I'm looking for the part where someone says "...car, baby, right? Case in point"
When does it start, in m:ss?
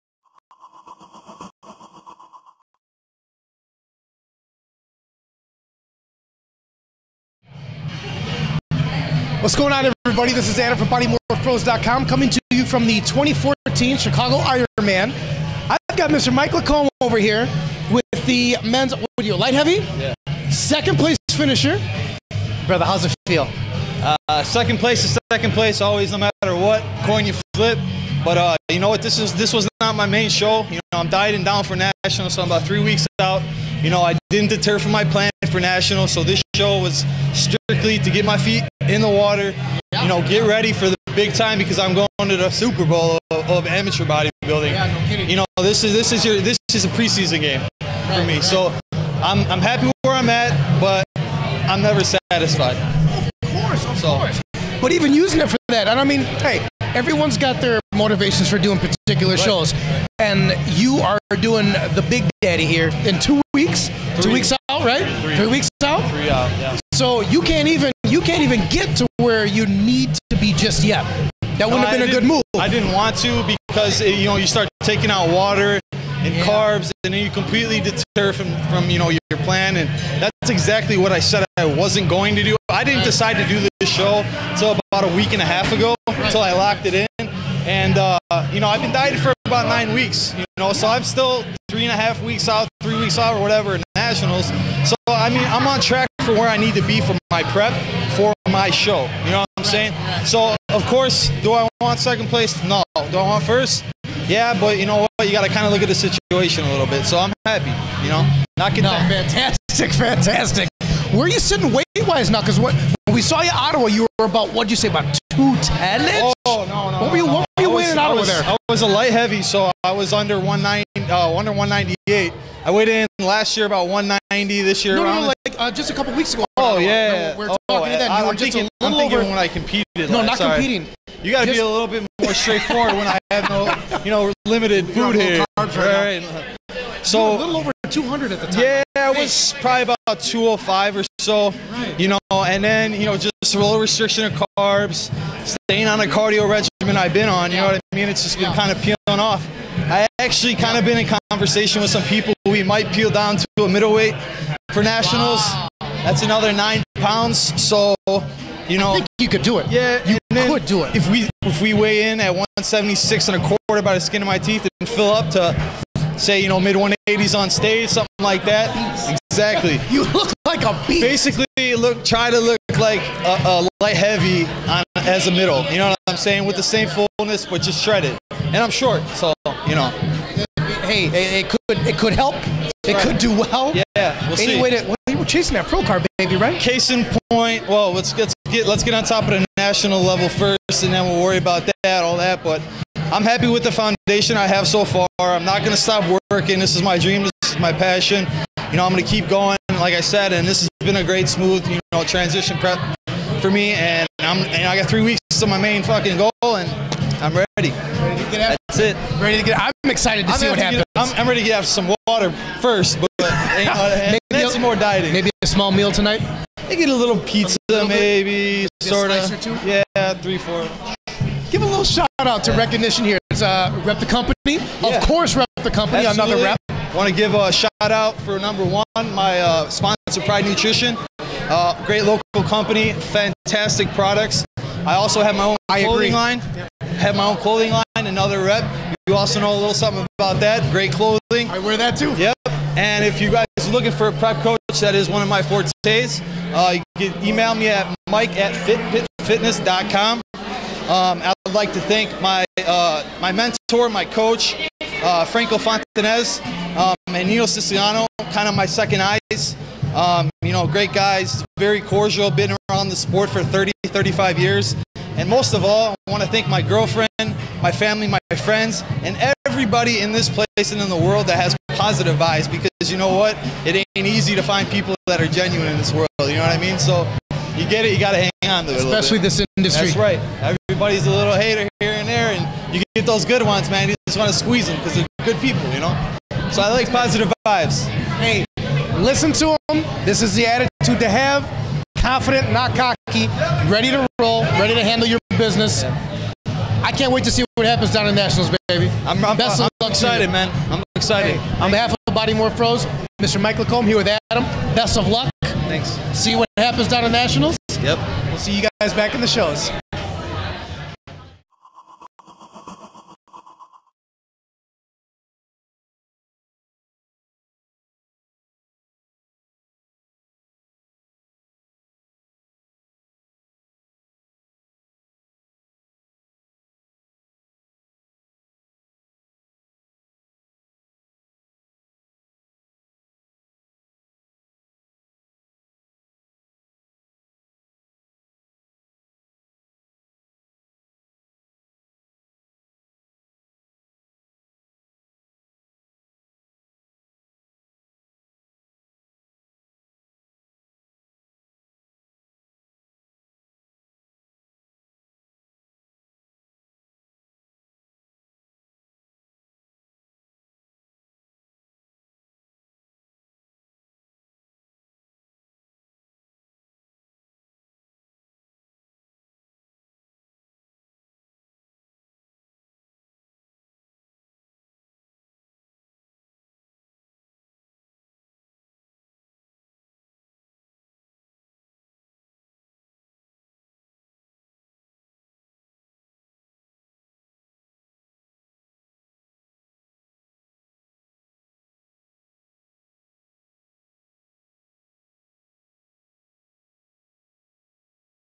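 3:05.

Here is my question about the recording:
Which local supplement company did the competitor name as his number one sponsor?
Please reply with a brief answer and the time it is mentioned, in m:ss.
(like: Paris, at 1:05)
Pride Nutrition, at 3:50.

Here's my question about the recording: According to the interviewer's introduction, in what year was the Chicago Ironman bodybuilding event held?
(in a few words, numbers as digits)
2014.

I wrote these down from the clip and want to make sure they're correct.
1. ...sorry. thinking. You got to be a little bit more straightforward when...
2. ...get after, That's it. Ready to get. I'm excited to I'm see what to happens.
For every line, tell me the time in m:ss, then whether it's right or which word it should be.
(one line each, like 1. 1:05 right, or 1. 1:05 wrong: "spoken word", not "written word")
1. 2:10 wrong: "competing", not "thinking"
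2. 3:28 right.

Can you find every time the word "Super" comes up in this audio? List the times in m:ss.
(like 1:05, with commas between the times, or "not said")
0:42.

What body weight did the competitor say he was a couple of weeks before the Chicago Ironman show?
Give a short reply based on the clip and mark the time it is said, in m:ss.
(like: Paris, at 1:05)
205, at 2:20.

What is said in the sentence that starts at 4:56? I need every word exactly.
I can't wait to see what happens down in Nationals, baby.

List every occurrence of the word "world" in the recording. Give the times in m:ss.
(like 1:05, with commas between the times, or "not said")
4:30, 4:35.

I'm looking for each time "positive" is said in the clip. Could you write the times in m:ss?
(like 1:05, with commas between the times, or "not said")
4:31, 4:46.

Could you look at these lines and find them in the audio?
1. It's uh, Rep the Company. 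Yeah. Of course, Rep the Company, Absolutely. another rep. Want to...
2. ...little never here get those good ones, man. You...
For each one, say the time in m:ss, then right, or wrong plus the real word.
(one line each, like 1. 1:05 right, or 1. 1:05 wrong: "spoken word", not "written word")
1. 3:43 right
2. 4:41 wrong: "hater", not "never".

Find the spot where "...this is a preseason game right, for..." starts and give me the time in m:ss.
0:46.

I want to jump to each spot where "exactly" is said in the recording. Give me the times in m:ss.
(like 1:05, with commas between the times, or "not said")
1:20, 2:49.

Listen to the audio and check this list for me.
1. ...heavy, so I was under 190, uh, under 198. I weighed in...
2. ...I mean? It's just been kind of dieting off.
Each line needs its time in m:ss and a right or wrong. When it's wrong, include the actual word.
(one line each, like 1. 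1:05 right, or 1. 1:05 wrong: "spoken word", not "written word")
1. 1:59 right
2. 2:27 wrong: "peeling", not "dieting".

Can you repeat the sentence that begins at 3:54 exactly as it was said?
I also have my own clothing line.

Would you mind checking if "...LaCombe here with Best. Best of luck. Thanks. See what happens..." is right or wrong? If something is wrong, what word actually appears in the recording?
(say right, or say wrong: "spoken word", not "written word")
wrong: "Adam", not "Best".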